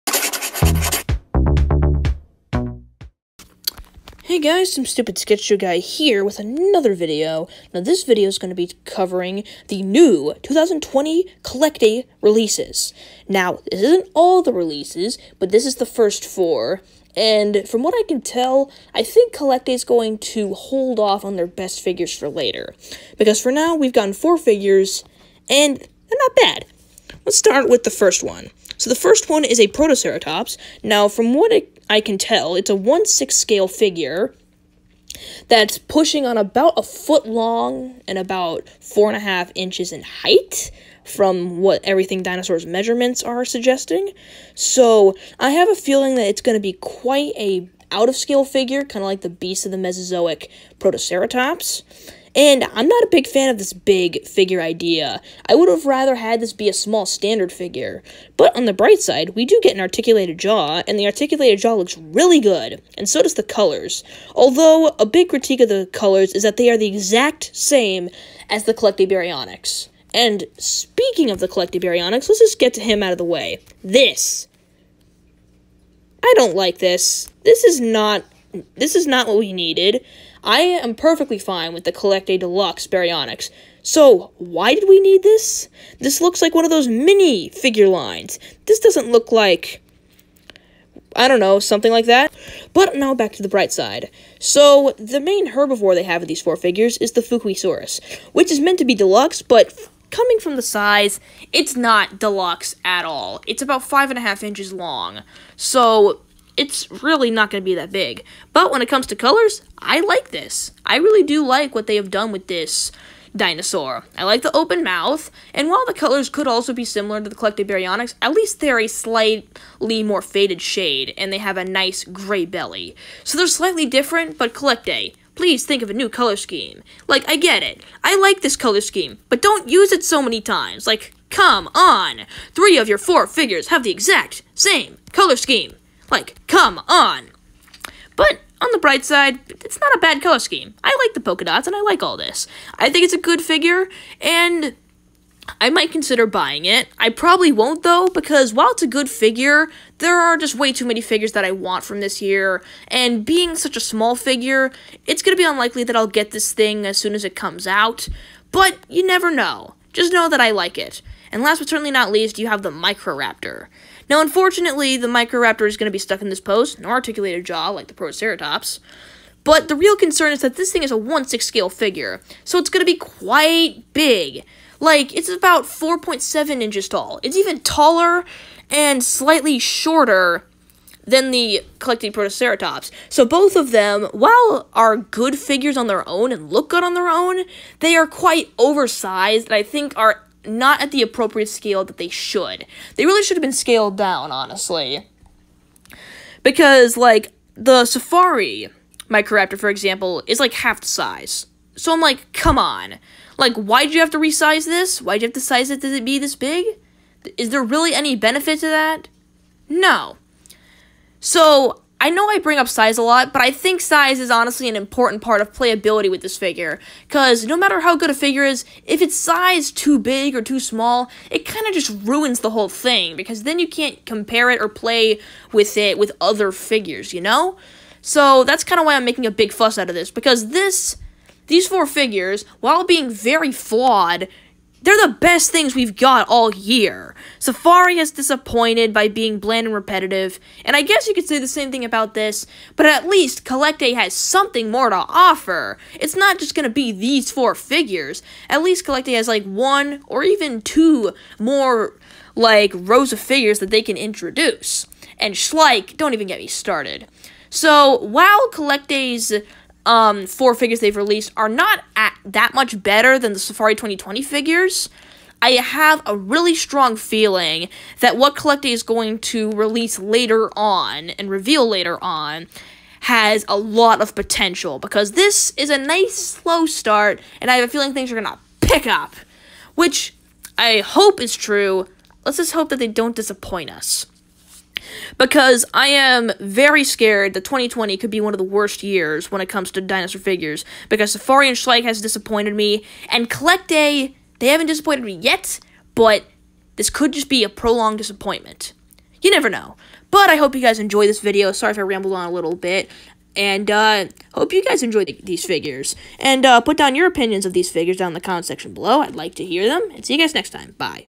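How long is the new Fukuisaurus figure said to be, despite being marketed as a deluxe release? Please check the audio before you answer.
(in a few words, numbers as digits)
5.5 inches.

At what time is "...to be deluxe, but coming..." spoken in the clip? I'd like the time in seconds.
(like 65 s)
98 s.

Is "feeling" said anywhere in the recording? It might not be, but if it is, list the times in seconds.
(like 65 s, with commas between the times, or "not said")
45 s, 266 s, 277 s.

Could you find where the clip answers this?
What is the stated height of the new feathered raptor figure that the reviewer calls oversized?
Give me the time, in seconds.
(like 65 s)
175 s.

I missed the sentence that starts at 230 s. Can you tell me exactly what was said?
Because this, these four figures, while being very flawed, they're the best things we've got all year.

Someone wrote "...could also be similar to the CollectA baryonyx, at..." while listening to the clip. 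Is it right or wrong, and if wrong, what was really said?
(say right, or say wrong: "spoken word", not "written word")
right.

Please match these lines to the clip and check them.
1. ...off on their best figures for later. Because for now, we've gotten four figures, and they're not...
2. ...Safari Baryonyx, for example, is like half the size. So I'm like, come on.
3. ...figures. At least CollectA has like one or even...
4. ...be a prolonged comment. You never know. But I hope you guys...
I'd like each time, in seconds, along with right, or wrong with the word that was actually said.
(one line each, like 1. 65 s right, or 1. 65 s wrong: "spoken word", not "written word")
1. 20 s right
2. 197 s wrong: "Microraptor", not "Baryonyx"
3. 247 s right
4. 297 s wrong: "disappointment", not "comment".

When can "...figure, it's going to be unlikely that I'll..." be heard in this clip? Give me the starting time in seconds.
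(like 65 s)
154 s.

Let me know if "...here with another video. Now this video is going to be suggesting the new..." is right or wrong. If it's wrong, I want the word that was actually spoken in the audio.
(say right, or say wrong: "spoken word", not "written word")
wrong: "covering", not "suggesting".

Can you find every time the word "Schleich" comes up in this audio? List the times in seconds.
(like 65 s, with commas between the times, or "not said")
255 s, 291 s.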